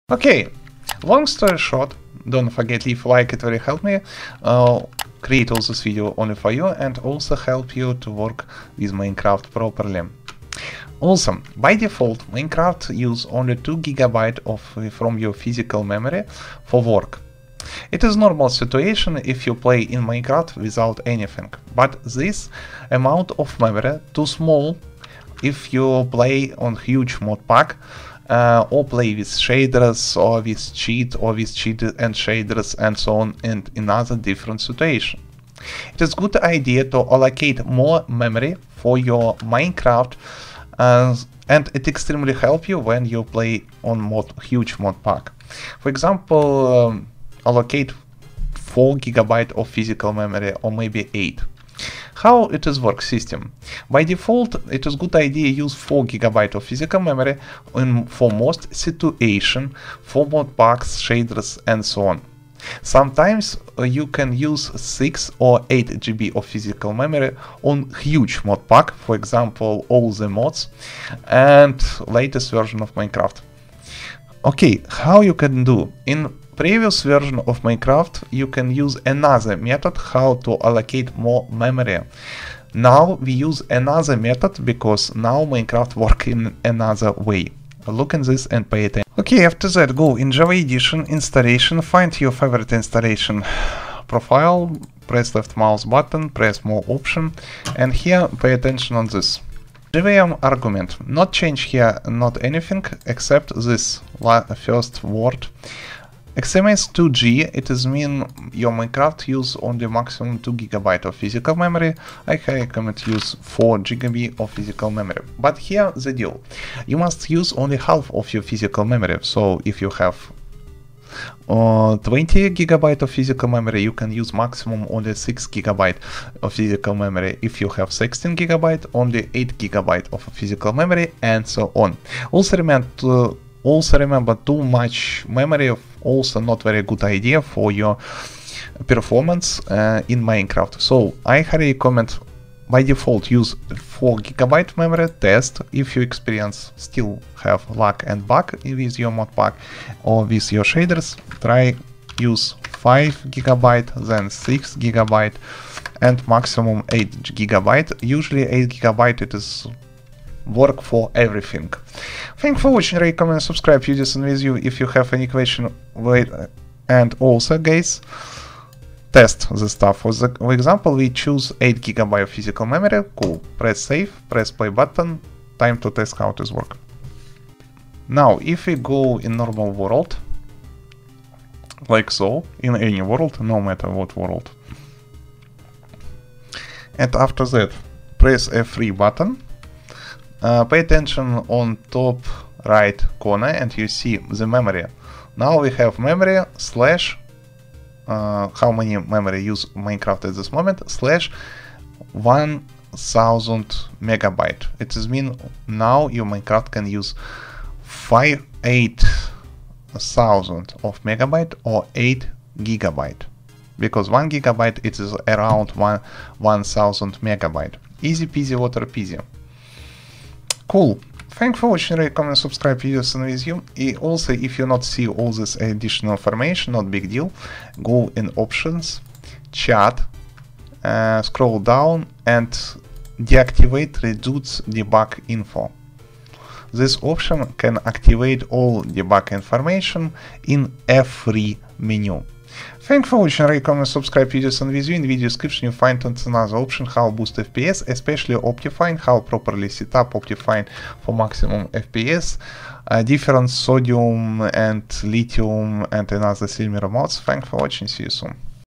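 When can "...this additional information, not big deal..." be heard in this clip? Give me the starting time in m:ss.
3:45.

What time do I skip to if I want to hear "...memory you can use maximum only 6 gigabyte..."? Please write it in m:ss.
2:03.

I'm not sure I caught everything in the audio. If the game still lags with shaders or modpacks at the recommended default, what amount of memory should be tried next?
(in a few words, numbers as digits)
5 gigabyte.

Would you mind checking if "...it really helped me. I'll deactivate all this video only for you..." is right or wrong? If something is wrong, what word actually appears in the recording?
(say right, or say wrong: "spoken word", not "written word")
wrong: "create", not "deactivate".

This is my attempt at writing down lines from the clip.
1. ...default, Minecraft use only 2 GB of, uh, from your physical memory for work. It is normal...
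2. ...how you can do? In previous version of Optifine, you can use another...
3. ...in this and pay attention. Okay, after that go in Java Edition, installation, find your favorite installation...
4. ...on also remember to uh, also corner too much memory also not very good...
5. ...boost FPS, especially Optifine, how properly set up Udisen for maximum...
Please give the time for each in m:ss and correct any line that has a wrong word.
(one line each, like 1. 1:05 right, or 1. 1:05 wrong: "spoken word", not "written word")
1. 0:11 right
2. 1:14 wrong: "Minecraft", not "Optifine"
3. 1:28 right
4. 2:11 wrong: "remember", not "corner"
5. 4:07 wrong: "Optifine", not "Udisen".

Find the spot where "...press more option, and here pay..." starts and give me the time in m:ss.
1:36.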